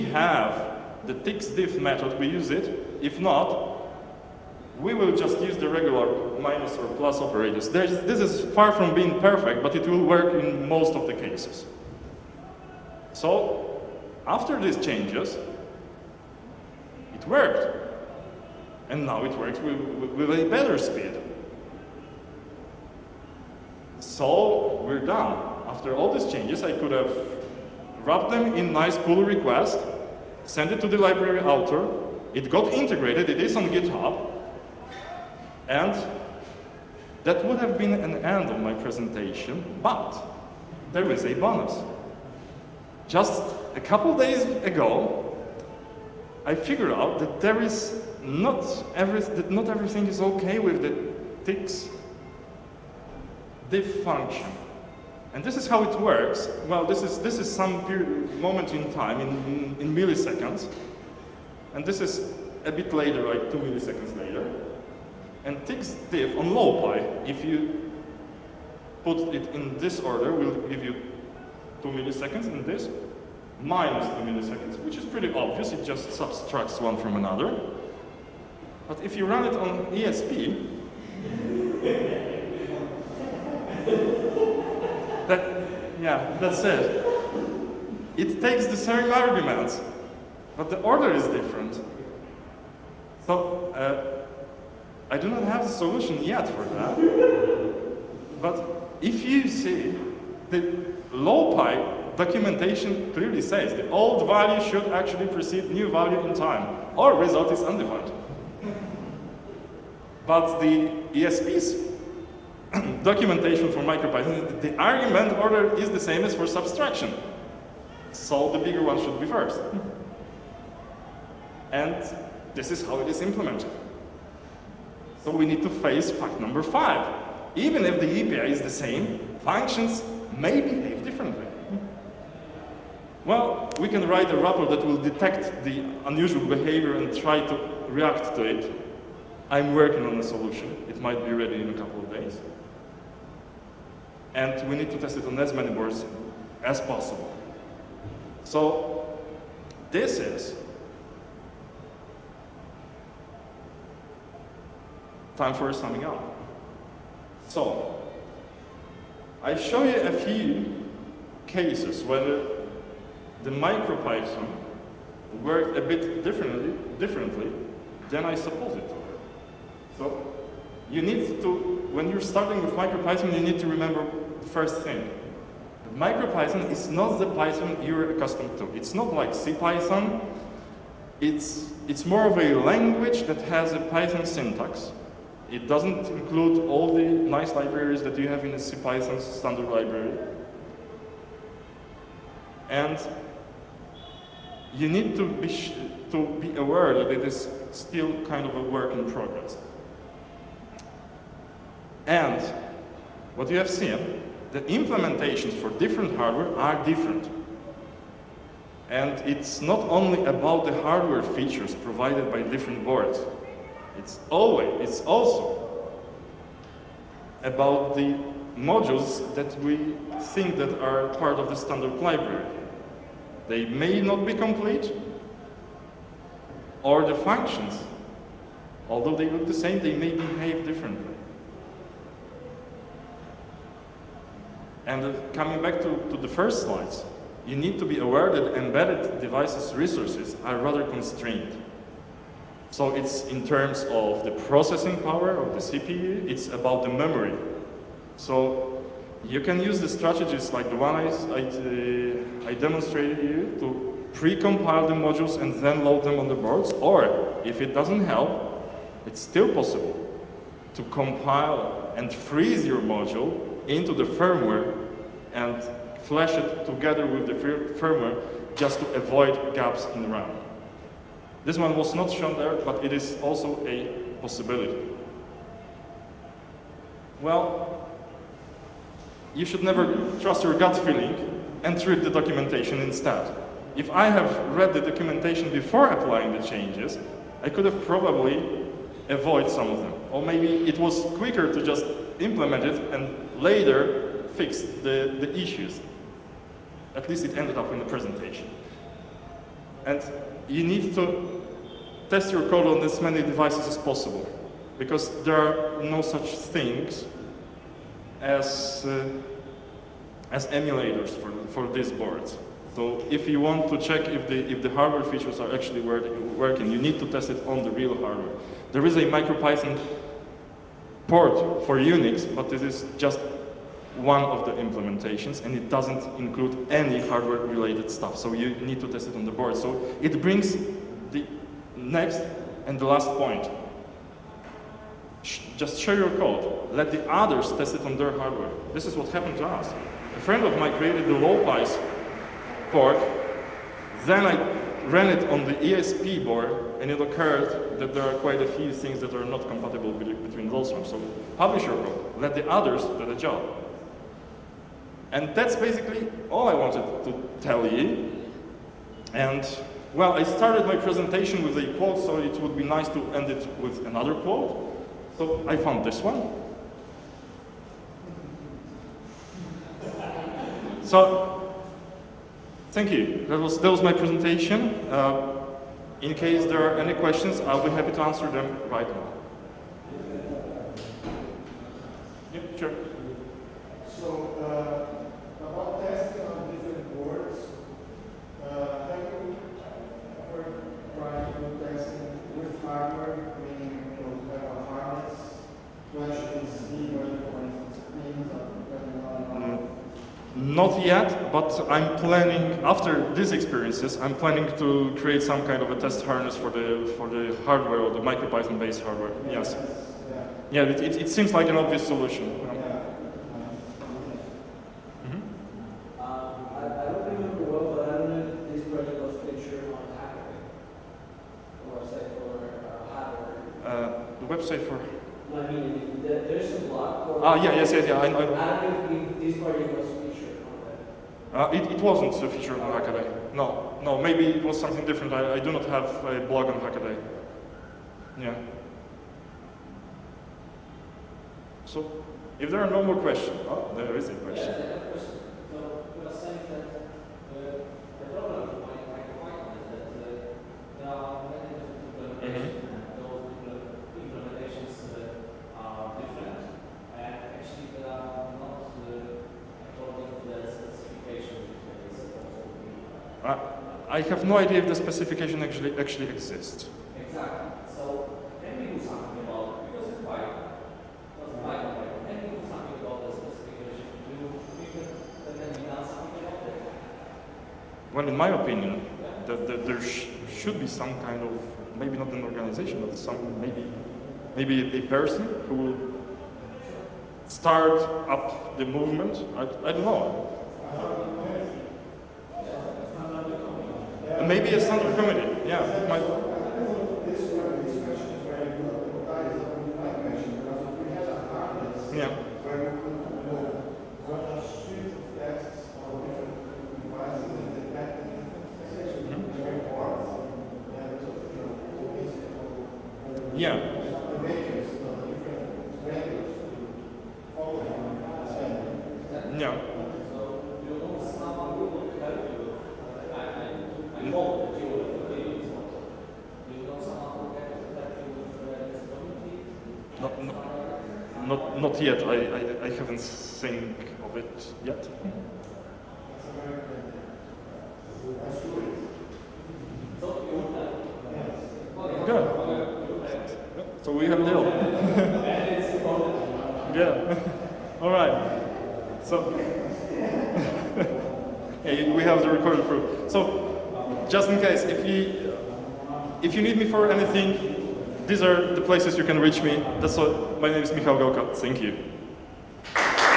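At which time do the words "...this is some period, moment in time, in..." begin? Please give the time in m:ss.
0:57.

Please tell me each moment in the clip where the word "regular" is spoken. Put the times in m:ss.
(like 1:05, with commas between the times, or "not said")
0:05.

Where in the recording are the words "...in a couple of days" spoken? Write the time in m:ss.
2:21.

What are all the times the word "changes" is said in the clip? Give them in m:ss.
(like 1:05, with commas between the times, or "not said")
0:14, 0:26, 4:46.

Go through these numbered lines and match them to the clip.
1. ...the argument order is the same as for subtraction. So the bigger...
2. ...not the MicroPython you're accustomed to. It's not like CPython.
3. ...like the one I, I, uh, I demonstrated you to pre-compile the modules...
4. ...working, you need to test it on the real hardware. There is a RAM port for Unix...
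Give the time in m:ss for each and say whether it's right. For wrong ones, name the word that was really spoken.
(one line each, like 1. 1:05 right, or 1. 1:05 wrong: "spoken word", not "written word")
1. 1:54 right
2. 2:56 wrong: "Python", not "MicroPython"
3. 4:10 right
4. 5:15 wrong: "MicroPython", not "RAM".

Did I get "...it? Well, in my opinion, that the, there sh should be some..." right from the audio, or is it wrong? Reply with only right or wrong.
right.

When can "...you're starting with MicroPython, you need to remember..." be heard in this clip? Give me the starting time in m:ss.
2:52.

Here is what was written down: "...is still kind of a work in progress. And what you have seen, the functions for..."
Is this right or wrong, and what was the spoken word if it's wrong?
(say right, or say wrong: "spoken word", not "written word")
wrong: "implementations", not "functions".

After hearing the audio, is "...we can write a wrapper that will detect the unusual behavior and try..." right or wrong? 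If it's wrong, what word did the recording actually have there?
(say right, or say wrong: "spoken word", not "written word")
right.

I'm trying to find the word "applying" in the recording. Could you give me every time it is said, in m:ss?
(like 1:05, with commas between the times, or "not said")
4:45.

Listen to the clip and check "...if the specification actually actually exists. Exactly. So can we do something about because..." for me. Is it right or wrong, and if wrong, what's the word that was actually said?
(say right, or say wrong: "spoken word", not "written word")
right.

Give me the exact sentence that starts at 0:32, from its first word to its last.
It got integrated, it is on GitHub.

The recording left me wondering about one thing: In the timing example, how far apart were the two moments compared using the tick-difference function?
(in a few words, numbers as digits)
2 milliseconds.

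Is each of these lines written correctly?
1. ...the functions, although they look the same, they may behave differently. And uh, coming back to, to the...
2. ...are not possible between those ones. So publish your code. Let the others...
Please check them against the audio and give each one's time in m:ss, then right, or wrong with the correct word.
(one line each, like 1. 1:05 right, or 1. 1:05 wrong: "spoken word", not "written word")
1. 3:47 right
2. 5:49 wrong: "compatible", not "possible".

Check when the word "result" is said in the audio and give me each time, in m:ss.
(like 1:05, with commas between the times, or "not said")
1:47.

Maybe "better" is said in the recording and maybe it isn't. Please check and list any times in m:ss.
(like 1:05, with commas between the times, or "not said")
0:20.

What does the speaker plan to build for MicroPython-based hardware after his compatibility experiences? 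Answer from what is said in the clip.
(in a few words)
A test harness.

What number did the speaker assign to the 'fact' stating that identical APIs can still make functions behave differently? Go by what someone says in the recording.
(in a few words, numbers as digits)
5.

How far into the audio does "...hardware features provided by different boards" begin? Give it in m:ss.
3:30.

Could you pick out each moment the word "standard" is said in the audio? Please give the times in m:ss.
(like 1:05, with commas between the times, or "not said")
3:09, 3:41.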